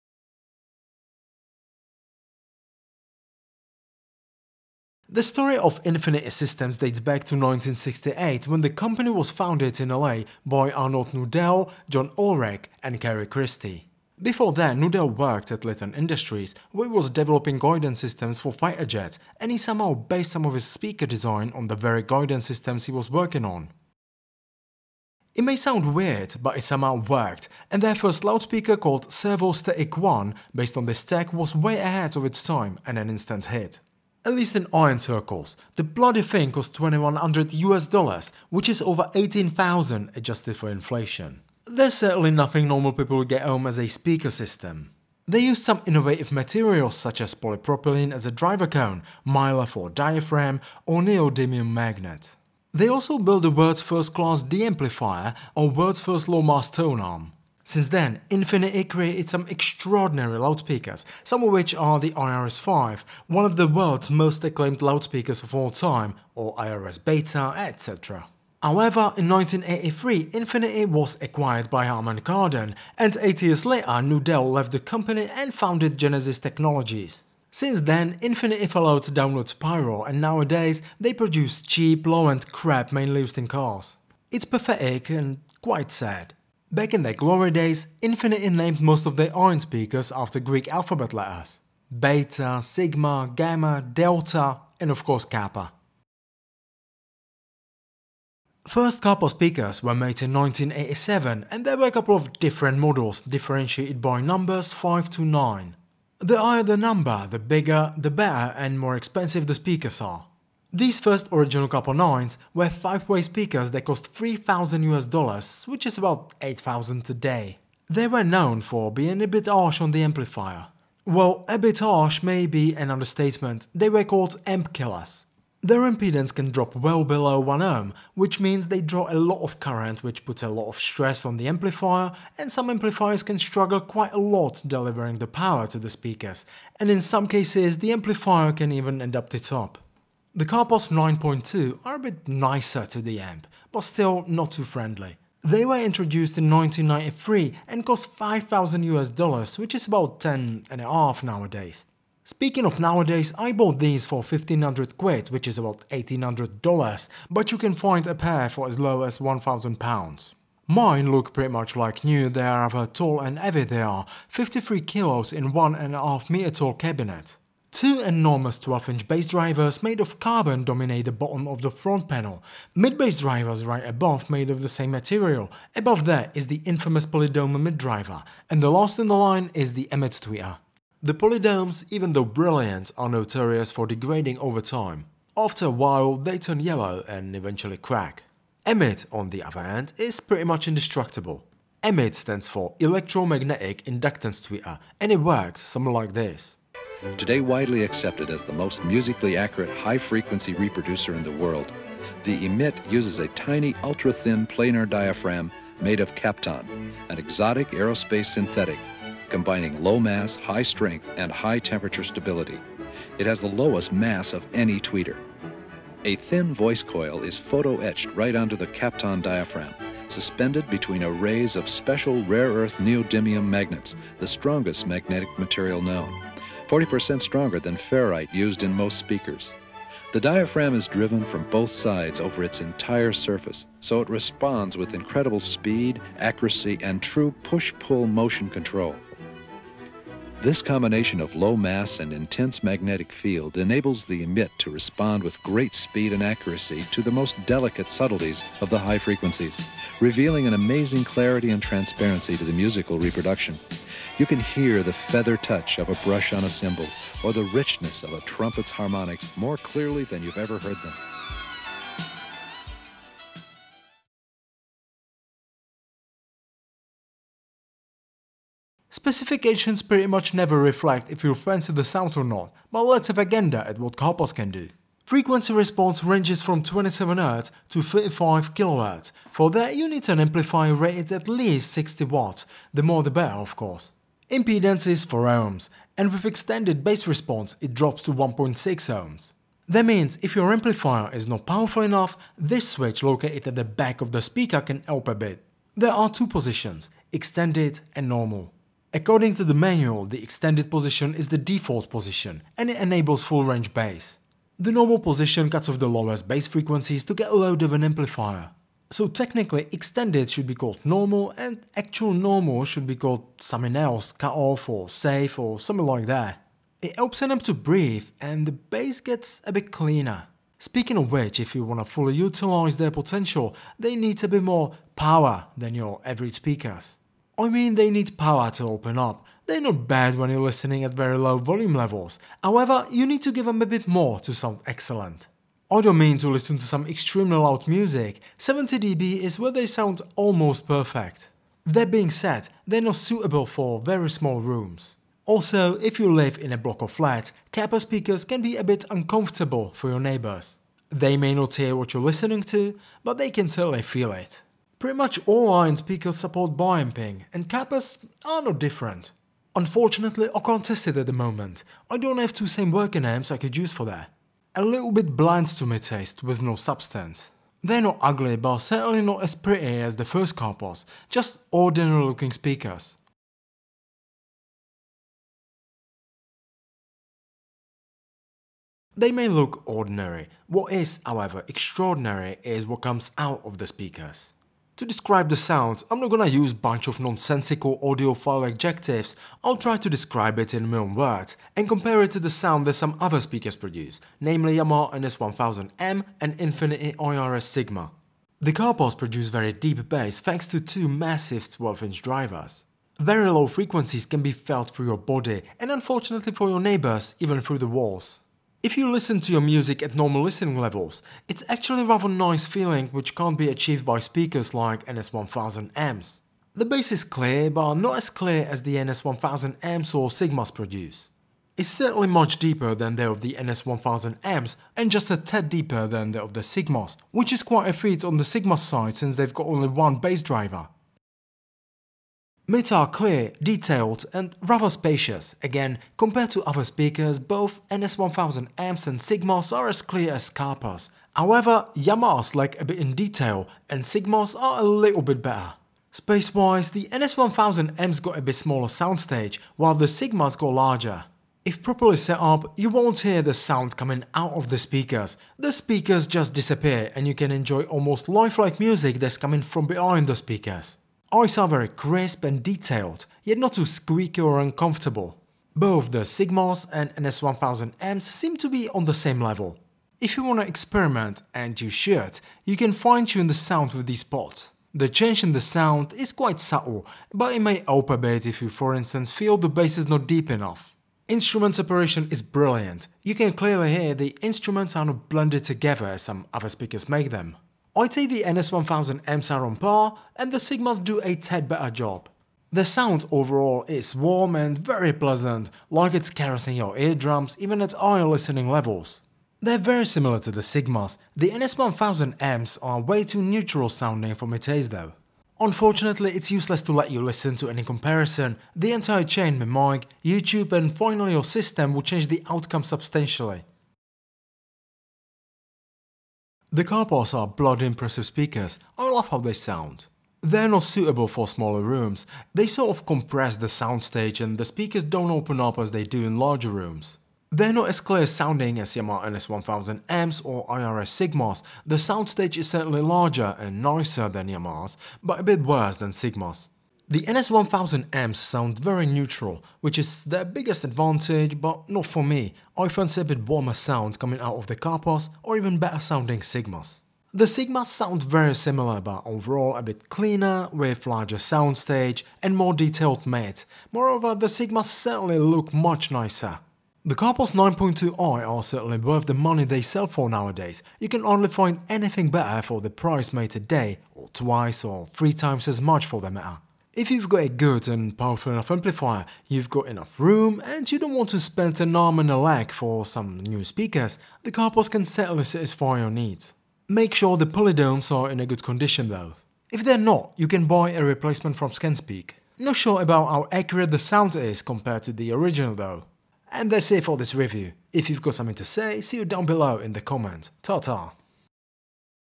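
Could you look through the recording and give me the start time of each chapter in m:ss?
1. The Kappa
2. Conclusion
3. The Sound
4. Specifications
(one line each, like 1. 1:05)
1. 1:36
2. 8:33
3. 6:13
4. 4:26.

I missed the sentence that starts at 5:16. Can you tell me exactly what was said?
It helps an amp to breathe and the bass gets a bit cleaner.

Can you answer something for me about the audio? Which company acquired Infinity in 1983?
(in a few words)
Harman Kardon.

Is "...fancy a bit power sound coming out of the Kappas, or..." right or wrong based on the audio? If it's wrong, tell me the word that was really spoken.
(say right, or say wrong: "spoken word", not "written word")
wrong: "warmer", not "power".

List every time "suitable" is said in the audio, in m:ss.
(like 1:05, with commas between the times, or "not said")
5:42, 8:40.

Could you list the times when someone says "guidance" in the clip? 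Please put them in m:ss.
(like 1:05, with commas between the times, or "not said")
0:17, 0:22.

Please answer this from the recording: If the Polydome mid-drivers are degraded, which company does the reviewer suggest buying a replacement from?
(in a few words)
ScanSpeak.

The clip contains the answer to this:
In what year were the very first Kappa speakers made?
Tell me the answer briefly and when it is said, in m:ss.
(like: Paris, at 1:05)
1987, at 1:40.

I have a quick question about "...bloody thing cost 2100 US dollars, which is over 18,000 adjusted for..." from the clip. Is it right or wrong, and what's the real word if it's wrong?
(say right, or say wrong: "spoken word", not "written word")
right.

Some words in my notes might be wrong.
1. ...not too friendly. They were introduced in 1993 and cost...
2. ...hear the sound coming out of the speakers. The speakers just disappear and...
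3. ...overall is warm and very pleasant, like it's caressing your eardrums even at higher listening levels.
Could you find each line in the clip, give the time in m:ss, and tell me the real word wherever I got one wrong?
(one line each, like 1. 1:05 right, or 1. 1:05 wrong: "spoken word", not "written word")
1. 2:24 right
2. 7:32 right
3. 8:13 right.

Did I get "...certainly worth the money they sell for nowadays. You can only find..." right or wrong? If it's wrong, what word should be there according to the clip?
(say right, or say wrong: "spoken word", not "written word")
right.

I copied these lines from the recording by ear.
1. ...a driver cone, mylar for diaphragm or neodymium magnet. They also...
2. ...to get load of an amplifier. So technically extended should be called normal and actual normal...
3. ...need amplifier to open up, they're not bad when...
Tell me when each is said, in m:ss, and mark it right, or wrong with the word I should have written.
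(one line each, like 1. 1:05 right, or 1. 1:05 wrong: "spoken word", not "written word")
1. 0:48 right
2. 5:07 right
3. 5:27 wrong: "power", not "amplifier".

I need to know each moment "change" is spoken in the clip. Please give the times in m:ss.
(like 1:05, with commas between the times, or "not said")
7:54, 8:31.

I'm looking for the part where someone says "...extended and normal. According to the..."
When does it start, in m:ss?
4:57.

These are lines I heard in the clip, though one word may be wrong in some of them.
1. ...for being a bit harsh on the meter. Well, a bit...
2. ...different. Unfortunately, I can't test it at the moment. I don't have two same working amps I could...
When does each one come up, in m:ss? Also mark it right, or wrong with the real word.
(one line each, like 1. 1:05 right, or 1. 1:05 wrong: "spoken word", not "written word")
1. 1:58 wrong: "amplifier", not "meter"
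2. 5:58 right.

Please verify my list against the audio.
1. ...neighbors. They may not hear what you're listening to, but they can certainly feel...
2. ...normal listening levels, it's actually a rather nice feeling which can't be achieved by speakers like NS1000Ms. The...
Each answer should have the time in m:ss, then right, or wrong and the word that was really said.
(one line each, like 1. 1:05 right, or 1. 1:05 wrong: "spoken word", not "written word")
1. 5:50 right
2. 6:49 right.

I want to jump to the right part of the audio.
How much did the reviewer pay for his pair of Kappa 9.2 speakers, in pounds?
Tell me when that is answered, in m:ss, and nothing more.
2:34.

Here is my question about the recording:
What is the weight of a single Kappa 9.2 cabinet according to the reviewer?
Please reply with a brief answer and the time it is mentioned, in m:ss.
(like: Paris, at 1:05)
53 kilos, at 2:44.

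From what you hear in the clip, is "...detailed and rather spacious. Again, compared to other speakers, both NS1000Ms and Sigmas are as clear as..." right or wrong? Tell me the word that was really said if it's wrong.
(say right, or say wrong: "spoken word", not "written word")
right.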